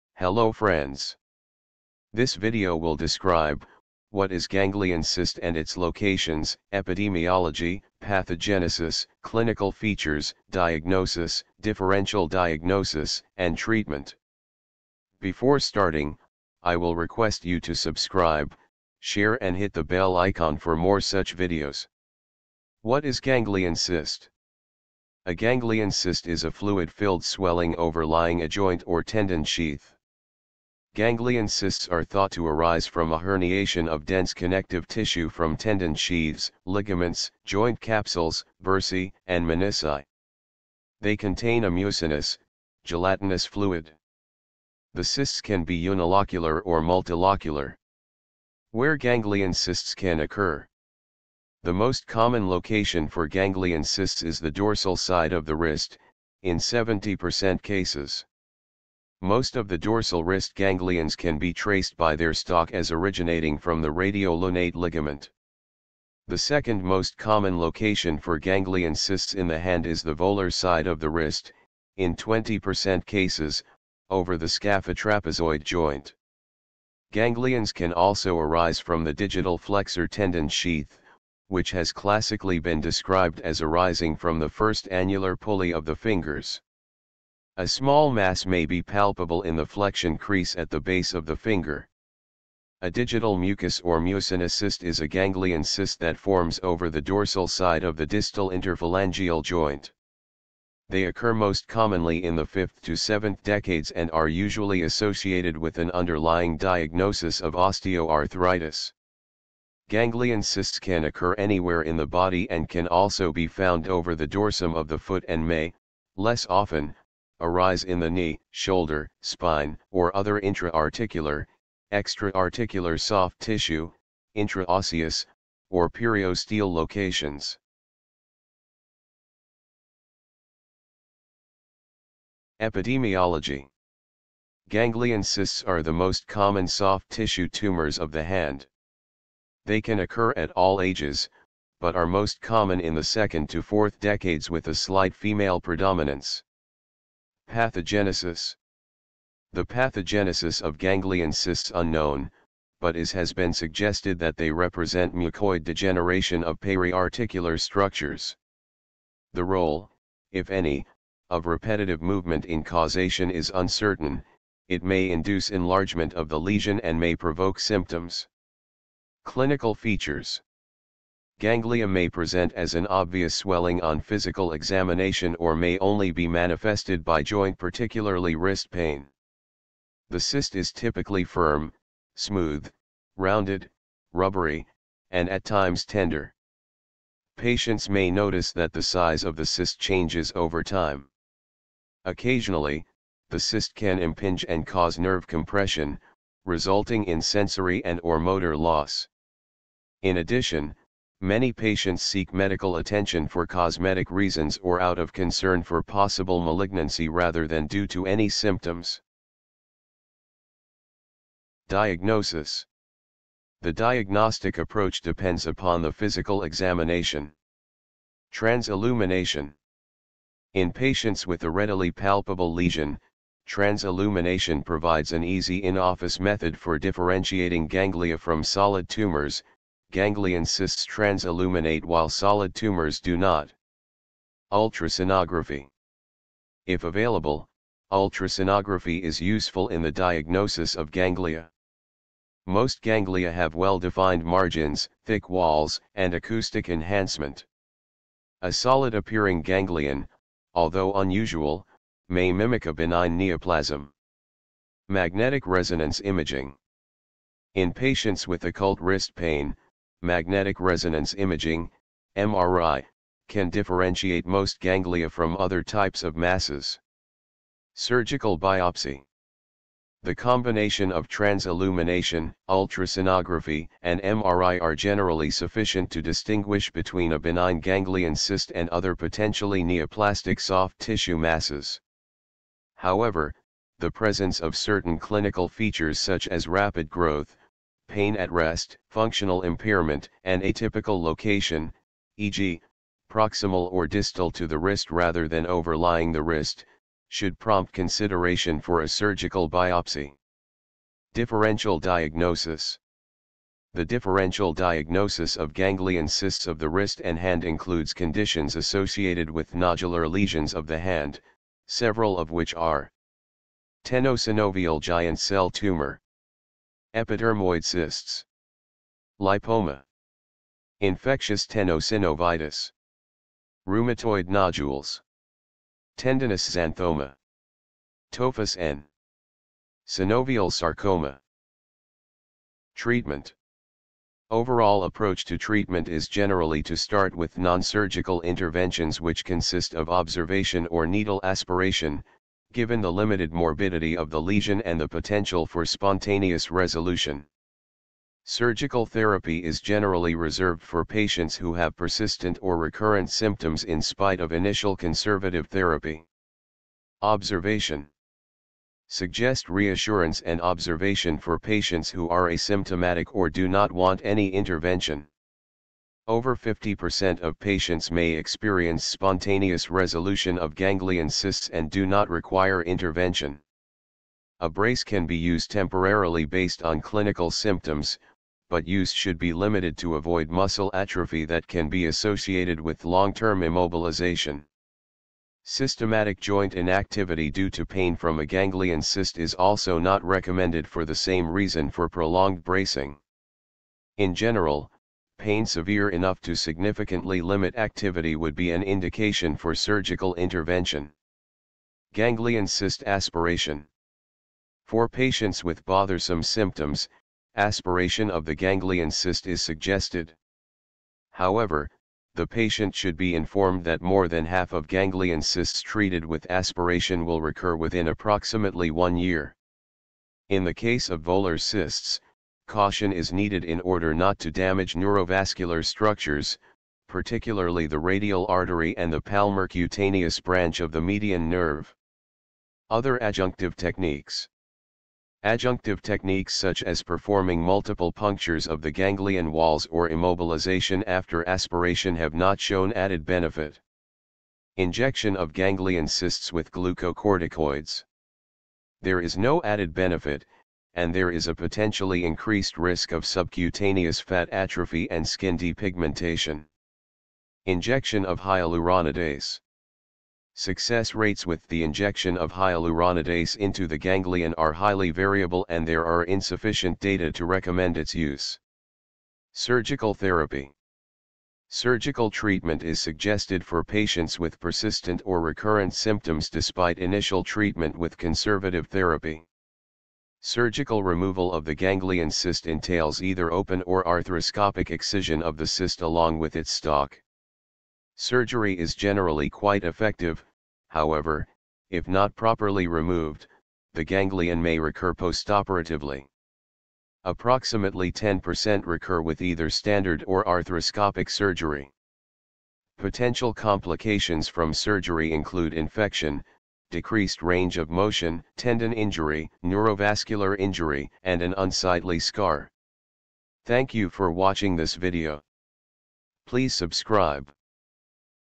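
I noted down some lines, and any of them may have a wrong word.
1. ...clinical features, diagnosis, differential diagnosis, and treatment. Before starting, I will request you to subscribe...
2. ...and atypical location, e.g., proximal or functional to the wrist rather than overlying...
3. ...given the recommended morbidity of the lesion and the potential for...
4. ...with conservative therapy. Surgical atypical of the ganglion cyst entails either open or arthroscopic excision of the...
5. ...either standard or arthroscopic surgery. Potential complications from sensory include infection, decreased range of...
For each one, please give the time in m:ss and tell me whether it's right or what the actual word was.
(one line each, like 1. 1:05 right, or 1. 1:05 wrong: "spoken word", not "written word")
1. 0:09 right
2. 4:50 wrong: "distal", not "functional"
3. 5:42 wrong: "limited", not "recommended"
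4. 7:57 wrong: "removal", not "atypical"
5. 8:19 wrong: "surgery", not "sensory".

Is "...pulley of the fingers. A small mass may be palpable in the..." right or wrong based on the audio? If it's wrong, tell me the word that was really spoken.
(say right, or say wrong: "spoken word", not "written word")
right.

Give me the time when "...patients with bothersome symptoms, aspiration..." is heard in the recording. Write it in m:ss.
6:44.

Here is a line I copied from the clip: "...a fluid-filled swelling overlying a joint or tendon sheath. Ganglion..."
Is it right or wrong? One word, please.
right.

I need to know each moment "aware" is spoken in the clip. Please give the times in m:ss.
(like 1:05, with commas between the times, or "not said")
not said.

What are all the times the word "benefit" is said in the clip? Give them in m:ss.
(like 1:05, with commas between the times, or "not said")
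7:23, 7:29.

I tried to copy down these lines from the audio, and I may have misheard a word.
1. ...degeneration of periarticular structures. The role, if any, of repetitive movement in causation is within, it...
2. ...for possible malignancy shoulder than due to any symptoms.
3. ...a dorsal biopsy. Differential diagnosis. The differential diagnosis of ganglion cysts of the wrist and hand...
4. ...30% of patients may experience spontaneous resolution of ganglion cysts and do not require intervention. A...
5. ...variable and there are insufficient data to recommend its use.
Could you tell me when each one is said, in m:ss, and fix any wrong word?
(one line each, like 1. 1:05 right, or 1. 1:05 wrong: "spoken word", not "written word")
1. 2:35 wrong: "uncertain", not "within"
2. 3:25 wrong: "rather", not "shoulder"
3. 4:58 wrong: "surgical", not "dorsal"
4. 6:06 wrong: "50", not "30"
5. 7:44 right.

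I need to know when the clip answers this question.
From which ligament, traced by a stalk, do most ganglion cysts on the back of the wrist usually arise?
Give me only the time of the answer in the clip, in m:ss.
1:03.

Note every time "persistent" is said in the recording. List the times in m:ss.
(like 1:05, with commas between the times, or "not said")
5:51, 7:54.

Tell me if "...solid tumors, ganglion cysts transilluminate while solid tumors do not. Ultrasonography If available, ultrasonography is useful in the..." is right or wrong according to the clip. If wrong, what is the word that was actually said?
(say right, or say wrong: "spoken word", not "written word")
right.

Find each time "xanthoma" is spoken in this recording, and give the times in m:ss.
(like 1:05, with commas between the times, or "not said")
5:26.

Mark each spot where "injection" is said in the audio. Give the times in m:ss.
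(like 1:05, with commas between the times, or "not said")
7:24, 7:37, 7:41.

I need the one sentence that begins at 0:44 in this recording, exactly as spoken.
The cysts can be unilocular or multilocular.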